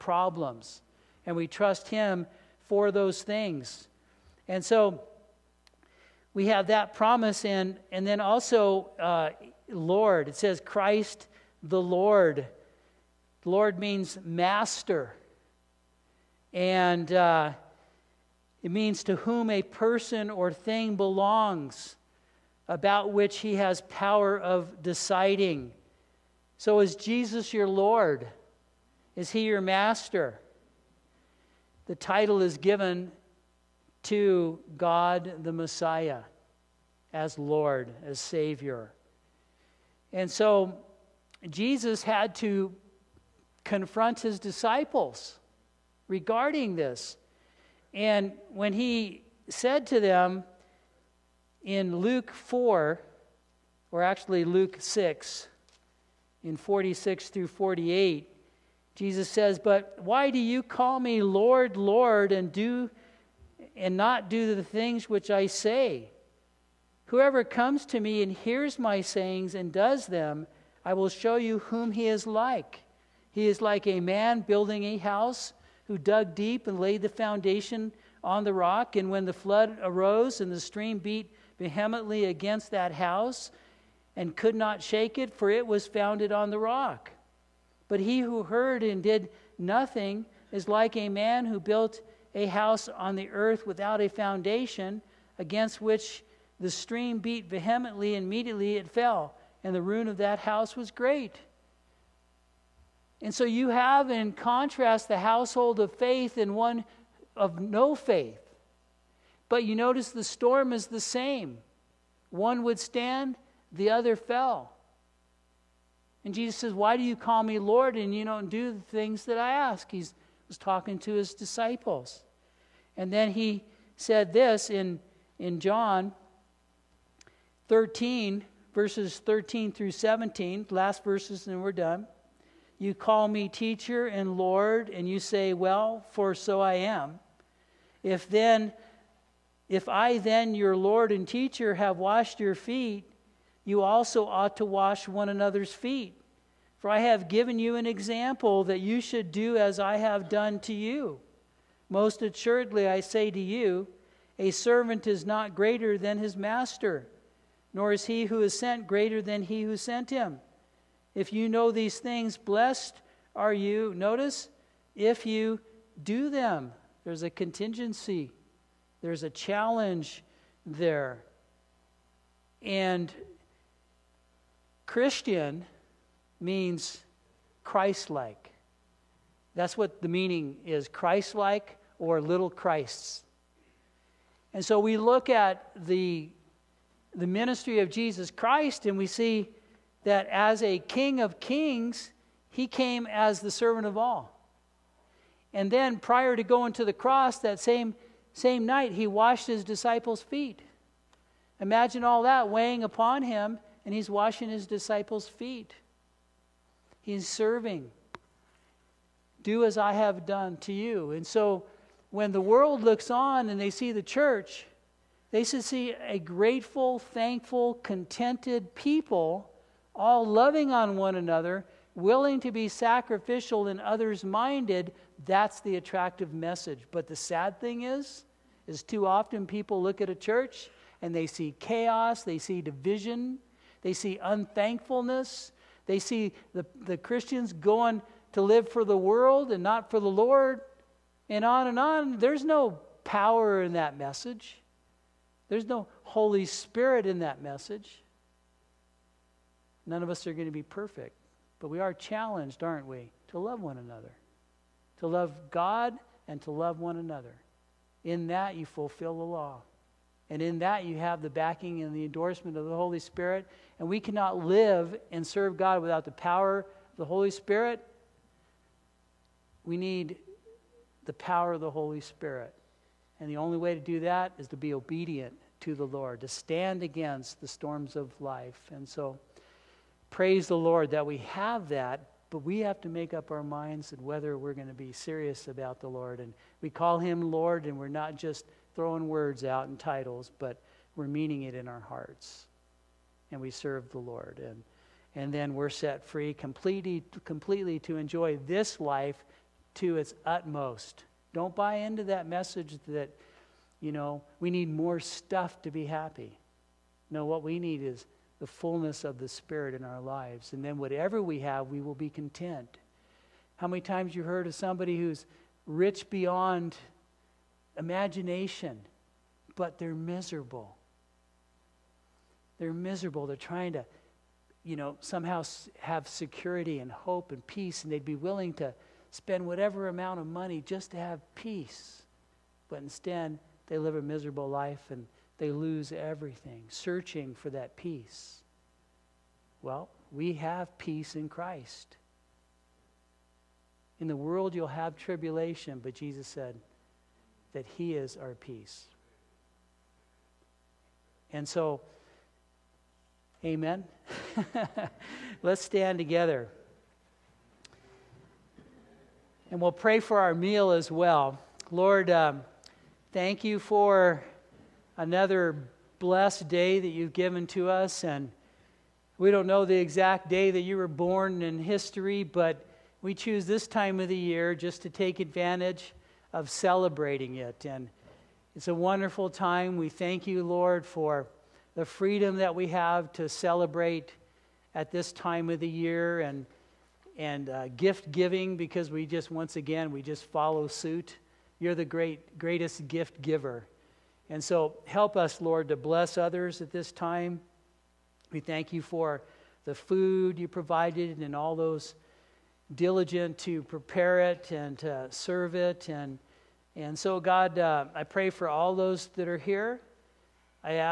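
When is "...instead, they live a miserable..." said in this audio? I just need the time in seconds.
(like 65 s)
332 s.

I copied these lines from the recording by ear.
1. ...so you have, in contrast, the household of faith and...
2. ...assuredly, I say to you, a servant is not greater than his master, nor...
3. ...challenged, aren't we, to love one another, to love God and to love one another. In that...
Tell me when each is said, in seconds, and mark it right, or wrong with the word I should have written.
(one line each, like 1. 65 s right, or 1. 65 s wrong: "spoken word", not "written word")
1. 103 s right
2. 152 s right
3. 251 s right.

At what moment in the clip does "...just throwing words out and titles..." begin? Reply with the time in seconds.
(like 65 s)
288 s.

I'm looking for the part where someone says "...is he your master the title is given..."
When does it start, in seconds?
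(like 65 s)
29 s.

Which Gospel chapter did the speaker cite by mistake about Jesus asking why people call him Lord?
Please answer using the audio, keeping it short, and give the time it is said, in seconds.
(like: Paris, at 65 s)
Luke 4, at 51 s.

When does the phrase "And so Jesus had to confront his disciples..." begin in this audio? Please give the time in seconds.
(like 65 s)
40 s.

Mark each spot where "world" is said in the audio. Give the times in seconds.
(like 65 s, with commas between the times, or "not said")
212 s, 238 s, 344 s.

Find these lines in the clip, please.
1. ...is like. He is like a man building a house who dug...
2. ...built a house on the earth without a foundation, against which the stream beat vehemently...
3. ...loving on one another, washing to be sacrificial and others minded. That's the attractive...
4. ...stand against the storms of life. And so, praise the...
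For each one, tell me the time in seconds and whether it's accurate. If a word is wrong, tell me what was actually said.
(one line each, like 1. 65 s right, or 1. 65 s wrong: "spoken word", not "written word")
1. 72 s right
2. 91 s right
3. 220 s wrong: "willing", not "washing"
4. 276 s right.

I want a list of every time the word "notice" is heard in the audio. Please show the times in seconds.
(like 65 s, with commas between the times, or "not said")
109 s, 163 s.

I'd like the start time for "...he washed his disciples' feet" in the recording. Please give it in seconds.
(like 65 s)
198 s.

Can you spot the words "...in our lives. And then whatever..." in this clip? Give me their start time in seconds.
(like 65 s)
309 s.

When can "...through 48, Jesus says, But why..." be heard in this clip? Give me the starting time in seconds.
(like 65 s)
57 s.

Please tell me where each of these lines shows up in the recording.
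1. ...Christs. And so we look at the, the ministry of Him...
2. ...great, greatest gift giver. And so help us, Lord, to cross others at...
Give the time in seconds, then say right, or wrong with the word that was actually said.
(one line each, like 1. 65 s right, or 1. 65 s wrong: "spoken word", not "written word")
1. 182 s wrong: "Jesus", not "Him"
2. 391 s wrong: "bless", not "cross".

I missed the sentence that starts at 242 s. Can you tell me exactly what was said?
There's no power in that message, there's no Holy Spirit in that message.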